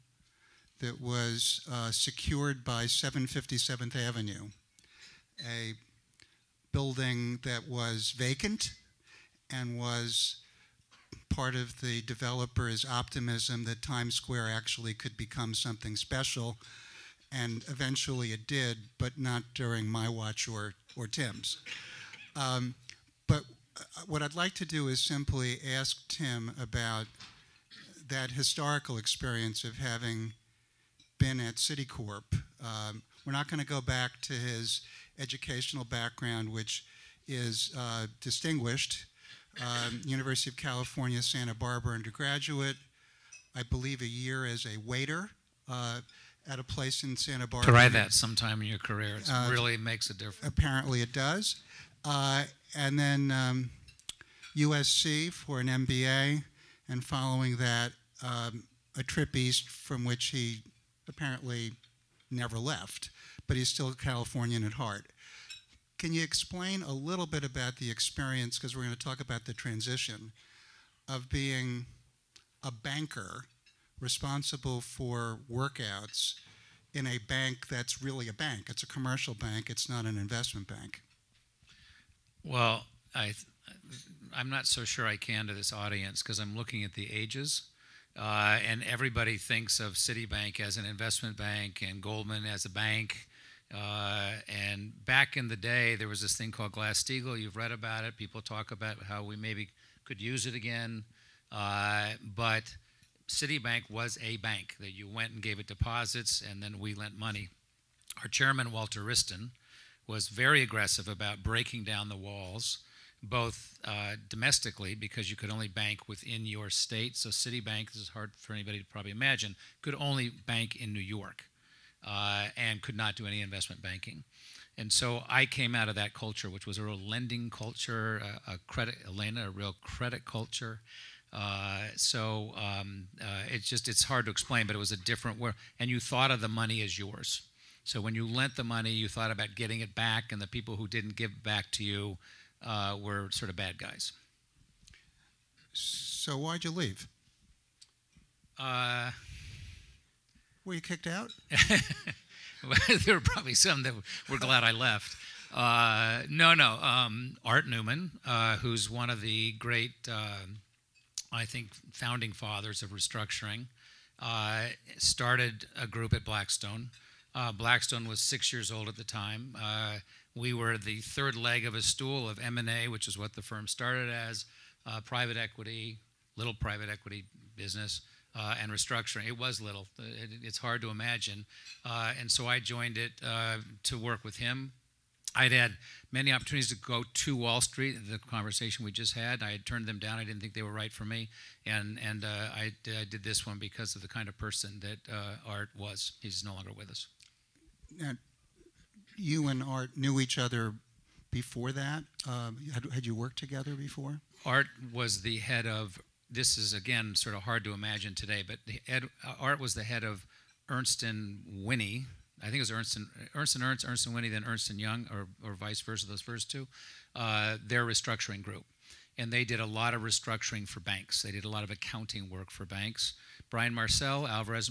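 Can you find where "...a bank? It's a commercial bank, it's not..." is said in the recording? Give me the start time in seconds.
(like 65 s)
78 s.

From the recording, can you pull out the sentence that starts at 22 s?
Um, but uh, what I'd like to do is simply ask Tim about that historical experience of having been at Citicorp.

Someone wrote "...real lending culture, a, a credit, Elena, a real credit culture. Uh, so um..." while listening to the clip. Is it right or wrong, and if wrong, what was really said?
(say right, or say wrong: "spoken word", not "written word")
right.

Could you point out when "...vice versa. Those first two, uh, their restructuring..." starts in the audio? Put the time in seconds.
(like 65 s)
215 s.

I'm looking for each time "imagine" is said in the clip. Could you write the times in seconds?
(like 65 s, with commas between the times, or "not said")
119 s, 180 s, 207 s.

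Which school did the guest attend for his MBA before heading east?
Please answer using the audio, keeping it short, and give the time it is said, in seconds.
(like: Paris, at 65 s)
USC, at 54 s.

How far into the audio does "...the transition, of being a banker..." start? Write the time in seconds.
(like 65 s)
69 s.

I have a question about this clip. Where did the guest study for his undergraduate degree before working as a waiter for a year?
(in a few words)
University of California, Santa Barbara.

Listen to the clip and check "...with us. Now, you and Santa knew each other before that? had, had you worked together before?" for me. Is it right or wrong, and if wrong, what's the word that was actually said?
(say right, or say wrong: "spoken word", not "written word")
wrong: "Art", not "Santa".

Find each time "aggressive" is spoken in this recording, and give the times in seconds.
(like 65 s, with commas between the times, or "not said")
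110 s.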